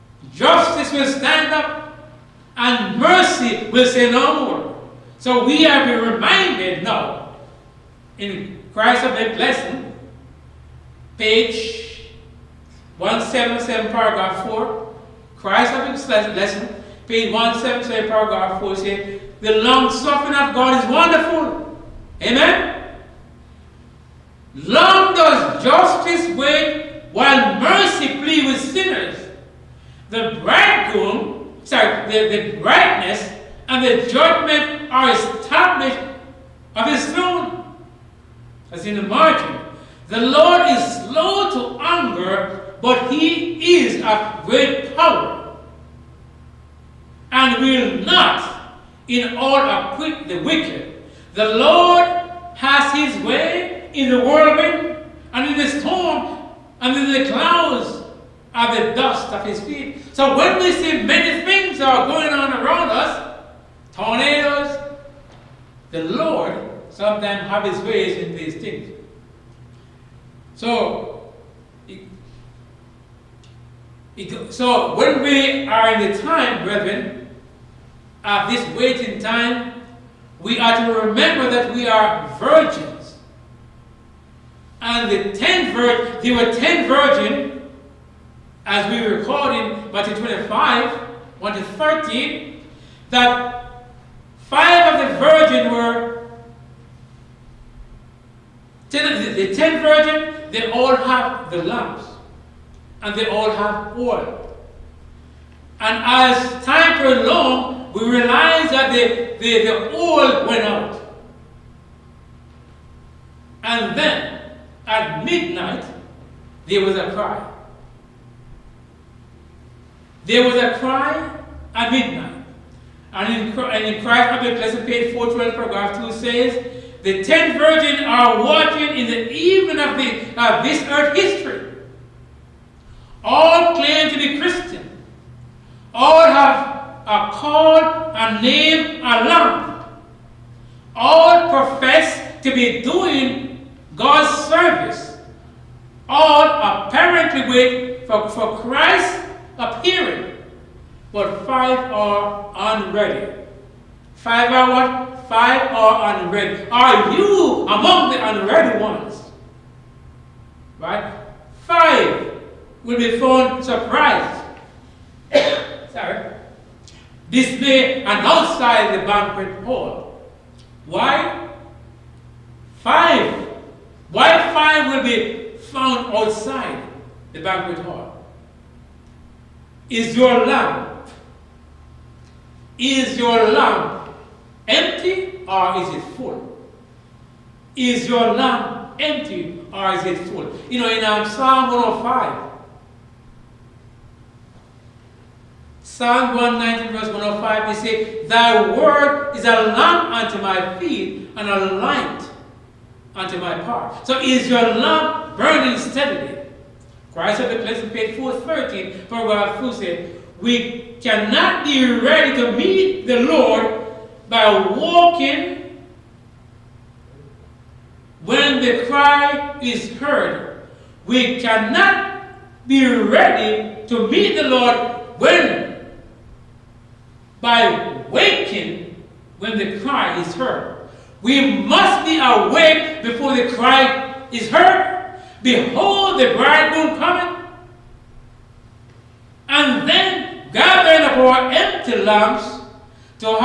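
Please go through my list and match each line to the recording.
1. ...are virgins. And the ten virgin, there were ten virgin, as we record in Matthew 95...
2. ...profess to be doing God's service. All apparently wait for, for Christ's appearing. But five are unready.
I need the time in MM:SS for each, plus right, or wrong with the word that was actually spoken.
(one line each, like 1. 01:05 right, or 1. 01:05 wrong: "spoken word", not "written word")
1. 01:21 wrong: "25", not "95"
2. 02:21 right.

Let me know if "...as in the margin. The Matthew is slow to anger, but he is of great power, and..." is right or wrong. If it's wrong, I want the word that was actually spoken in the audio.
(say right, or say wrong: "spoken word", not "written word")
wrong: "Lord", not "Matthew".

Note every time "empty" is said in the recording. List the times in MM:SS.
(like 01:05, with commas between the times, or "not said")
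03:04, 03:08, 04:01.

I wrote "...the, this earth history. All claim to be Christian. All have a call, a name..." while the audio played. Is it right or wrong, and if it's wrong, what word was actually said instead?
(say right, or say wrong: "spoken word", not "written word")
right.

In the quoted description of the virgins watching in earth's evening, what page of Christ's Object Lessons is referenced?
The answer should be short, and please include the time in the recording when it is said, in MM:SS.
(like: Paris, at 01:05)
412, at 02:04.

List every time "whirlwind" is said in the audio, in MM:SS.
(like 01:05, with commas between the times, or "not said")
00:54.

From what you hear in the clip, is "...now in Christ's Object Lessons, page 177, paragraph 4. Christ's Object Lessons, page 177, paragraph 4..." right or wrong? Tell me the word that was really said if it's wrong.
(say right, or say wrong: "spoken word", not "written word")
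right.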